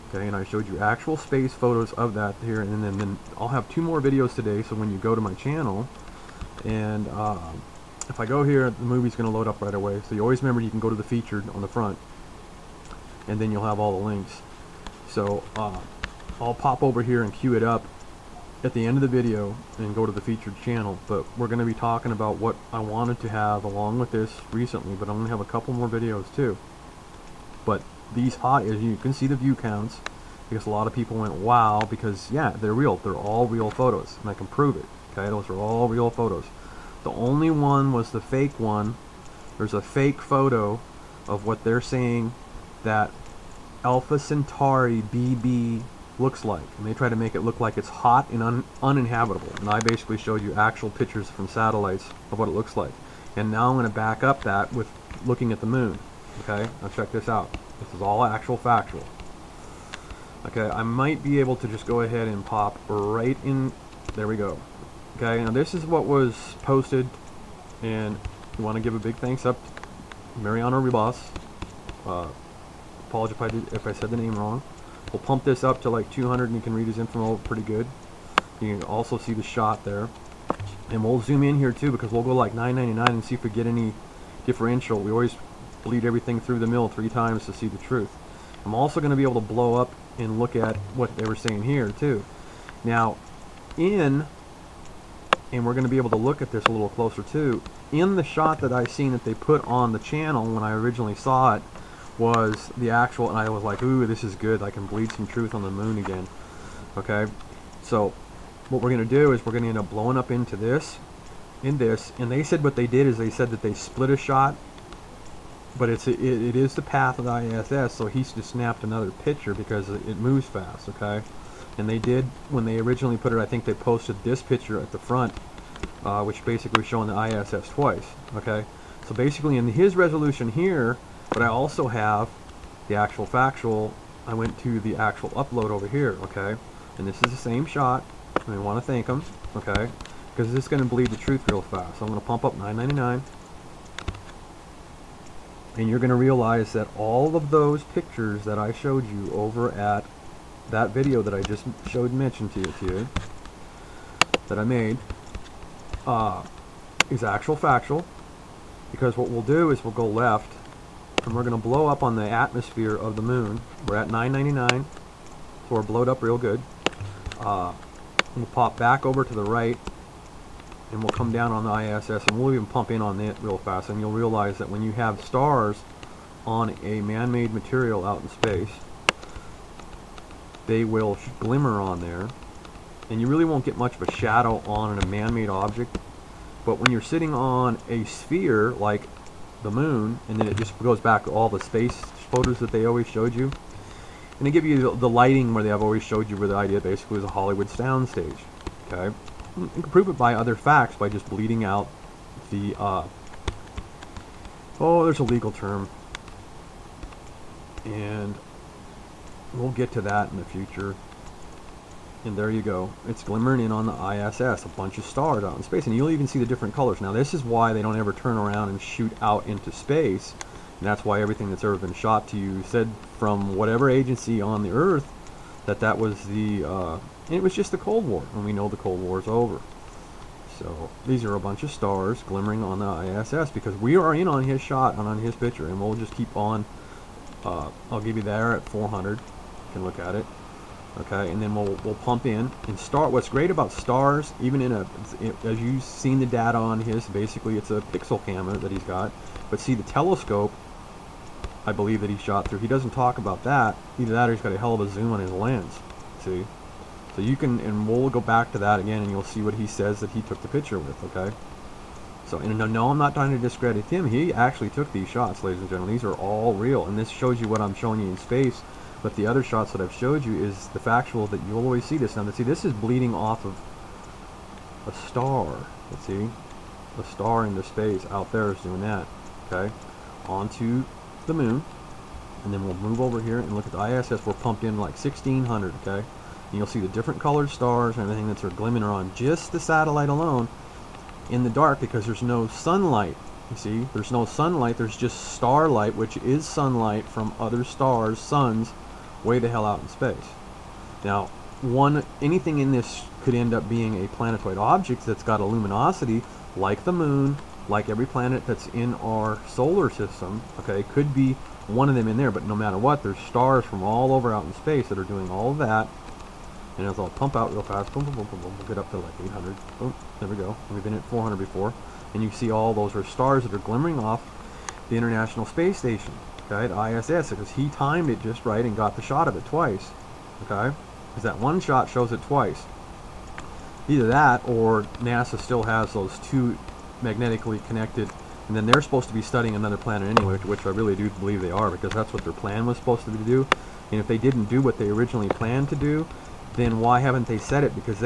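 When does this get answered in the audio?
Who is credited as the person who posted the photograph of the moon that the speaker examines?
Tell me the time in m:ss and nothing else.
1:10.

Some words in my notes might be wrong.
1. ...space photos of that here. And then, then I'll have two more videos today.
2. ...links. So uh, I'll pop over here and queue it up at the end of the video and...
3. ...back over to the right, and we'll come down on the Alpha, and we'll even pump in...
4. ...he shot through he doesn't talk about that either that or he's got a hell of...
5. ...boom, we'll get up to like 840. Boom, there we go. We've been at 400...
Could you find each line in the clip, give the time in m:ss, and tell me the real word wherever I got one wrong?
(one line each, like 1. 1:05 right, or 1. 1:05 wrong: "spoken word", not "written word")
1. 0:01 right
2. 0:14 right
3. 2:48 wrong: "ISS", not "Alpha"
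4. 4:12 right
5. 5:18 wrong: "800", not "840".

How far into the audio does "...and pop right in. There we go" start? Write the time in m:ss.
1:02.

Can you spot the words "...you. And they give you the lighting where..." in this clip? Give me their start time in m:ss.
3:13.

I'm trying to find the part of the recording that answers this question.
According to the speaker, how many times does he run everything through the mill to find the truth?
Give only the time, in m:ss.
1:26.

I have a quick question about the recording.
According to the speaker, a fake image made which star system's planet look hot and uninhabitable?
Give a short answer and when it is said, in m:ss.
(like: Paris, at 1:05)
Alpha Centauri BB, at 0:43.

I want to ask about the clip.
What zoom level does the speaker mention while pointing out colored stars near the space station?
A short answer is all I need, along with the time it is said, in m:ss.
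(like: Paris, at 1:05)
1600, at 4:44.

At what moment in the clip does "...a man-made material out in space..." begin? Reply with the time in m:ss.
2:56.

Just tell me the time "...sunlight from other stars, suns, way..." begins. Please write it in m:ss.
4:56.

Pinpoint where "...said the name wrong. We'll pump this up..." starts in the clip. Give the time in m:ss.
1:13.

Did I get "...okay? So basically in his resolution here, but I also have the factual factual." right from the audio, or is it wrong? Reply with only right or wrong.
wrong.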